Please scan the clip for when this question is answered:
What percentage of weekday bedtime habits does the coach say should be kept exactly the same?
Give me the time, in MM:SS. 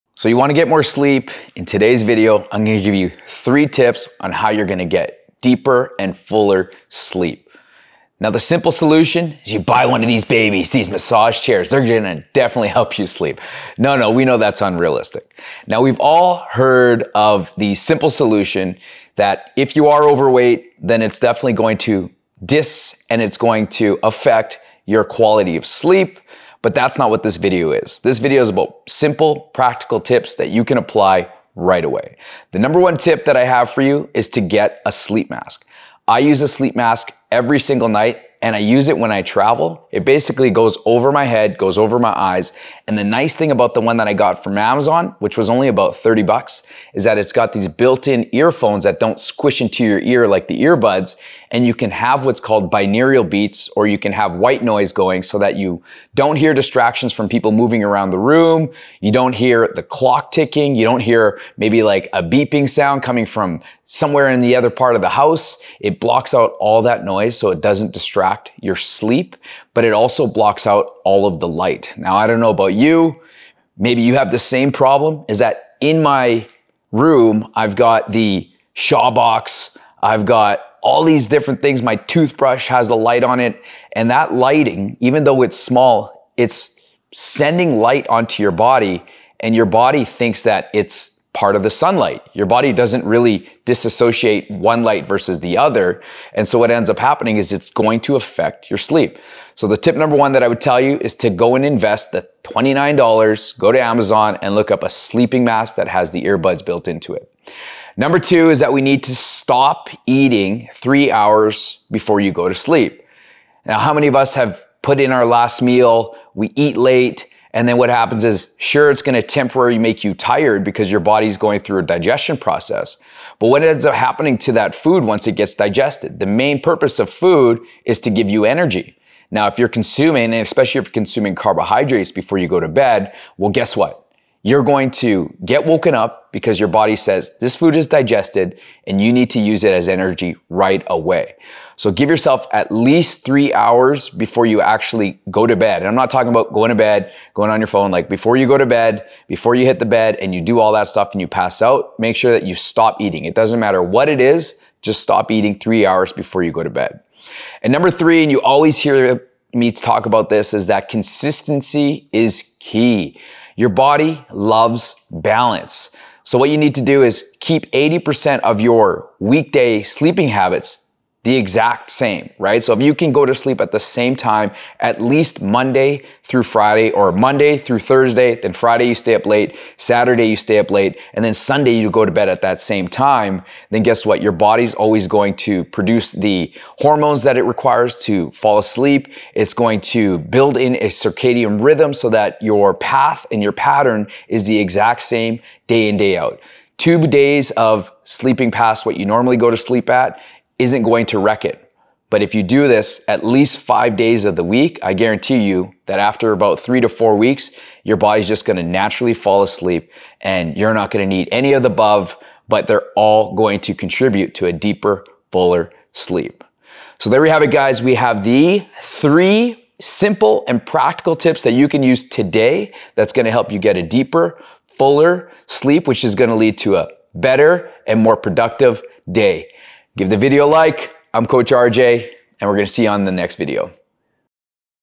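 02:47.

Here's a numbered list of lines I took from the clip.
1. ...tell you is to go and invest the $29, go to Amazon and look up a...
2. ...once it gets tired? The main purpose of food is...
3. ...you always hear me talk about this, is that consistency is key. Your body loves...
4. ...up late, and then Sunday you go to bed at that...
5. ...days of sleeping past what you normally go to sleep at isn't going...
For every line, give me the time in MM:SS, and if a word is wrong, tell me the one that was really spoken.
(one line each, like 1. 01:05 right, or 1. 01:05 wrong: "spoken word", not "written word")
1. 01:40 right
2. 02:05 wrong: "digested", not "tired"
3. 02:38 right
4. 03:00 right
5. 03:17 right.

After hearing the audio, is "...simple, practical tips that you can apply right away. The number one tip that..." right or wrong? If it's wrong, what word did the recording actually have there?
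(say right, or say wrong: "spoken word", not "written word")
right.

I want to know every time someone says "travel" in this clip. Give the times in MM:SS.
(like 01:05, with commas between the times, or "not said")
00:39.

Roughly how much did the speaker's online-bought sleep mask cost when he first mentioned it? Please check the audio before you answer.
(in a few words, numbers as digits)
30 bucks.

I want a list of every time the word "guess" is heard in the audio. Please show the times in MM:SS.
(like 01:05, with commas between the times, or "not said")
02:13, 03:03.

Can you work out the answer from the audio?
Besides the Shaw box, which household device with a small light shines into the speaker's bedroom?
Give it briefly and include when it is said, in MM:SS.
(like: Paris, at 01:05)
toothbrush, at 01:21.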